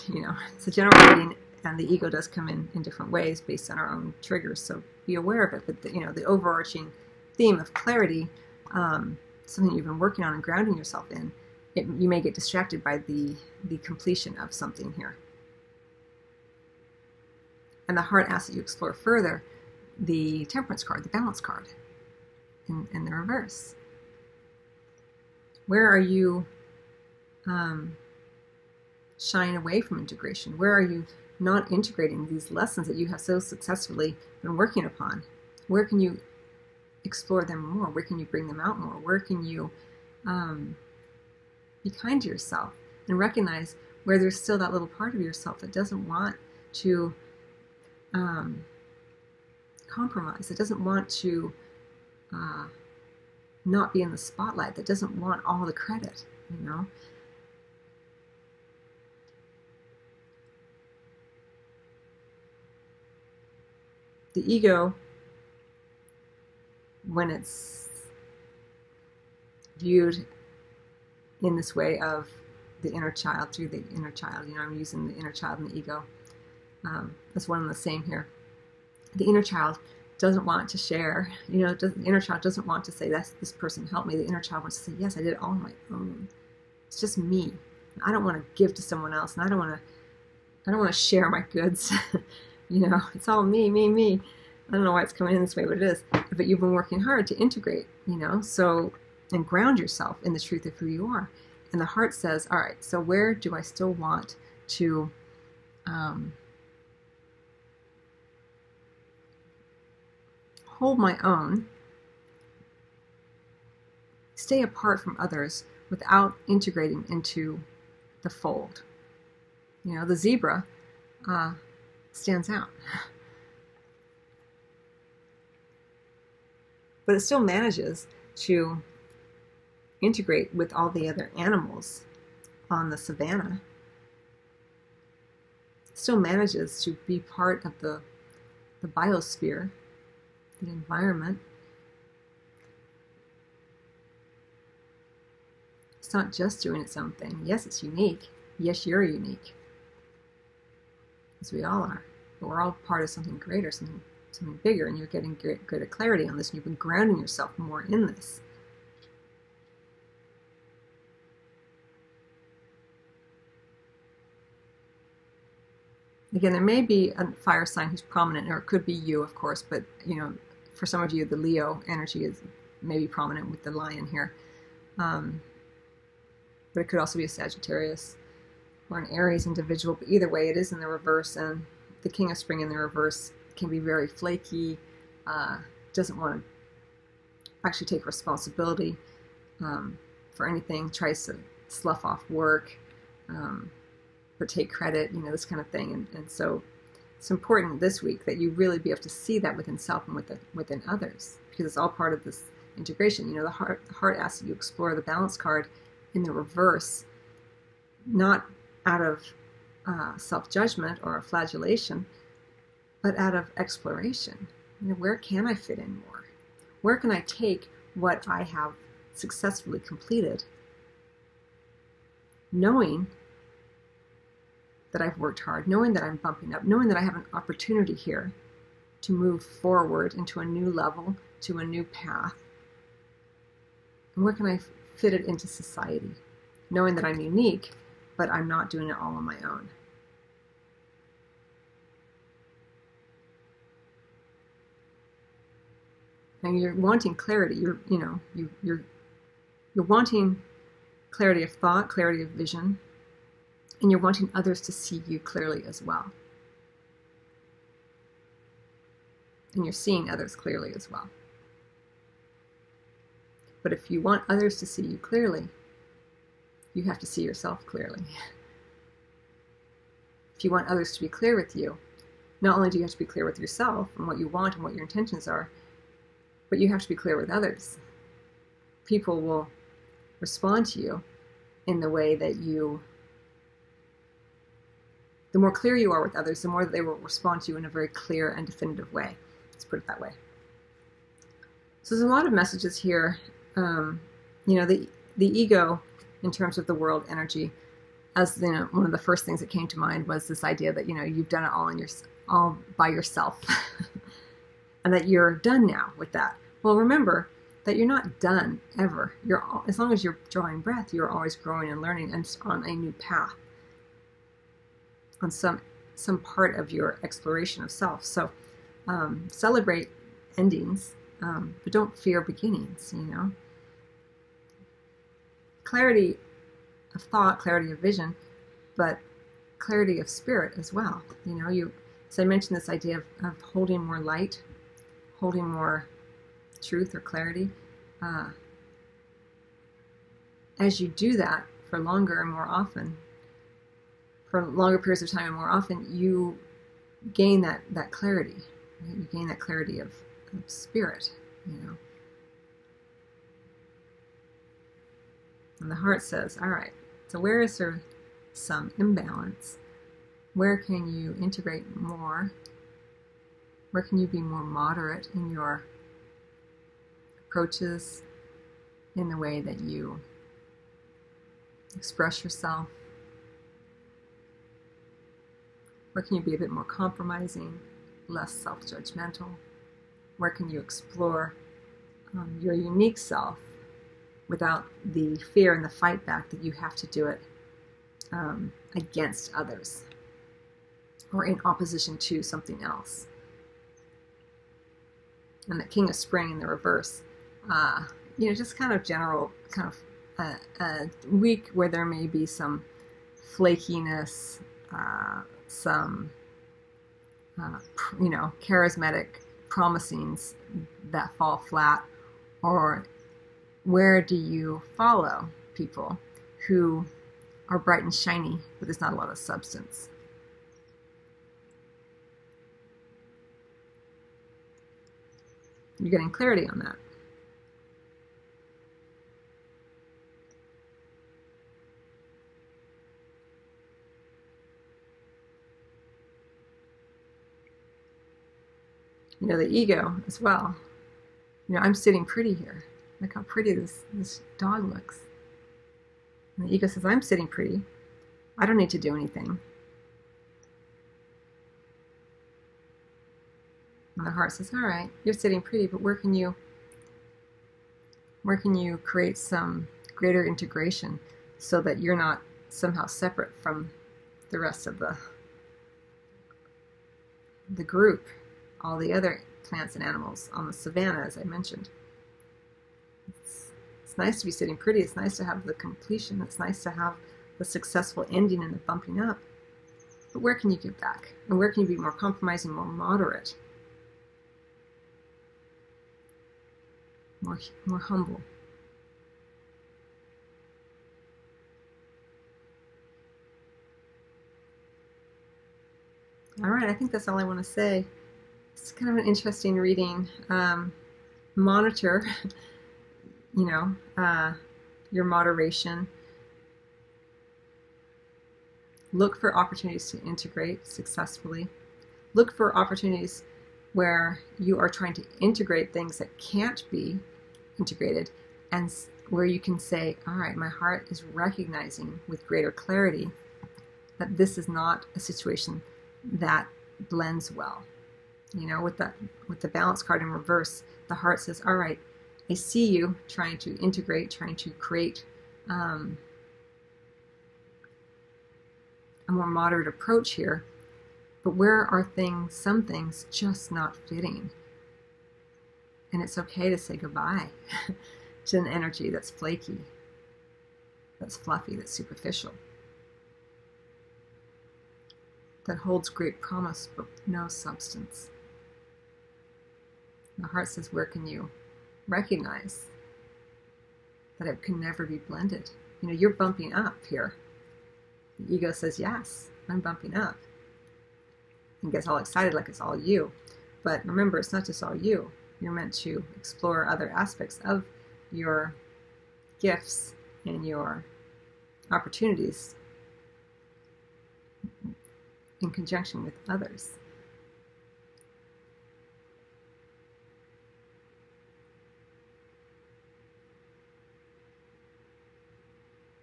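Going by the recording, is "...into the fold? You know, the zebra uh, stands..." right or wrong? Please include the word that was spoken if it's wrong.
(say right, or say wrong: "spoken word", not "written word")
right.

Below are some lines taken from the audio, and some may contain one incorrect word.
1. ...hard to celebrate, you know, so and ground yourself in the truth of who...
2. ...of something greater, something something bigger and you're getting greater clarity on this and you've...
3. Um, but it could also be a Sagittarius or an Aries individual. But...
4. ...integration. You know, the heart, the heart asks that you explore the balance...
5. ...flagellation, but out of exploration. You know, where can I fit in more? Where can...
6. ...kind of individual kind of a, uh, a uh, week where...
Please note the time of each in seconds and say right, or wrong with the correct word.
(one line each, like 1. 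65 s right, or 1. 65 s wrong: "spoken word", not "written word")
1. 97 s wrong: "integrate", not "celebrate"
2. 153 s right
3. 174 s right
4. 202 s right
5. 211 s right
6. 398 s wrong: "general", not "individual".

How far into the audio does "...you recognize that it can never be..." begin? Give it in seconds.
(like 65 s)
561 s.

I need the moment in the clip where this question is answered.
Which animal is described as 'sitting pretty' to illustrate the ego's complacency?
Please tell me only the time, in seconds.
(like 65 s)
444 s.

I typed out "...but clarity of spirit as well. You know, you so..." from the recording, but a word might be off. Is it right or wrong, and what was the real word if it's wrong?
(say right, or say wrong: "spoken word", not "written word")
right.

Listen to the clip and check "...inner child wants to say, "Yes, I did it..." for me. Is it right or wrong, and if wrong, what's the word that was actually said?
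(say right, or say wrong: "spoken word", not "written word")
right.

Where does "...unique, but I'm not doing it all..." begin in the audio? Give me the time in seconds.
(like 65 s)
237 s.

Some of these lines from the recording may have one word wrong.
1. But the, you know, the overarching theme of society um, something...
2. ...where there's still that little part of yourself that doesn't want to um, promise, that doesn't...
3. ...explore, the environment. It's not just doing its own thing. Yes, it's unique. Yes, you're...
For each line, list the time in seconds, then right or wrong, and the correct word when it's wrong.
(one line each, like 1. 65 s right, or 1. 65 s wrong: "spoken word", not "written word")
1. 5 s wrong: "clarity", not "society"
2. 44 s wrong: "compromise", not "promise"
3. 138 s wrong: "biosphere", not "explore".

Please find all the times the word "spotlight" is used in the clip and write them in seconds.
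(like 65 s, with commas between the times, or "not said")
54 s.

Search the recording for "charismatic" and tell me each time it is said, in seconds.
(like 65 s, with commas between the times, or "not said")
408 s.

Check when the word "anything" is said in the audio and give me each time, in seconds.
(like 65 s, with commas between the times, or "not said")
190 s, 448 s.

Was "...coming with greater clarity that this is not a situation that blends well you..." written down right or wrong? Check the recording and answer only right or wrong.
wrong.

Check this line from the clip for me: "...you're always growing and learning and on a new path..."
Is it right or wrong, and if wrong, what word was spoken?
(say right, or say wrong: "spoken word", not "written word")
right.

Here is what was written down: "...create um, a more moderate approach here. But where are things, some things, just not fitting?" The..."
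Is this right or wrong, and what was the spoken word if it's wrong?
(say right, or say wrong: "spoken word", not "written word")
wrong: "And", not "The".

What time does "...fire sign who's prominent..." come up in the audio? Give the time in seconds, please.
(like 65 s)
167 s.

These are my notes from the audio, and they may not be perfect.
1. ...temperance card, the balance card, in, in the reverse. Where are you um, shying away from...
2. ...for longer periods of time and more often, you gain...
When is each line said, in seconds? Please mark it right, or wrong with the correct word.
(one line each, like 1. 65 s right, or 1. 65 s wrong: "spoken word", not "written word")
1. 20 s right
2. 344 s right.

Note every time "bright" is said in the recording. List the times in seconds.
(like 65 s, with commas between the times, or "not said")
417 s.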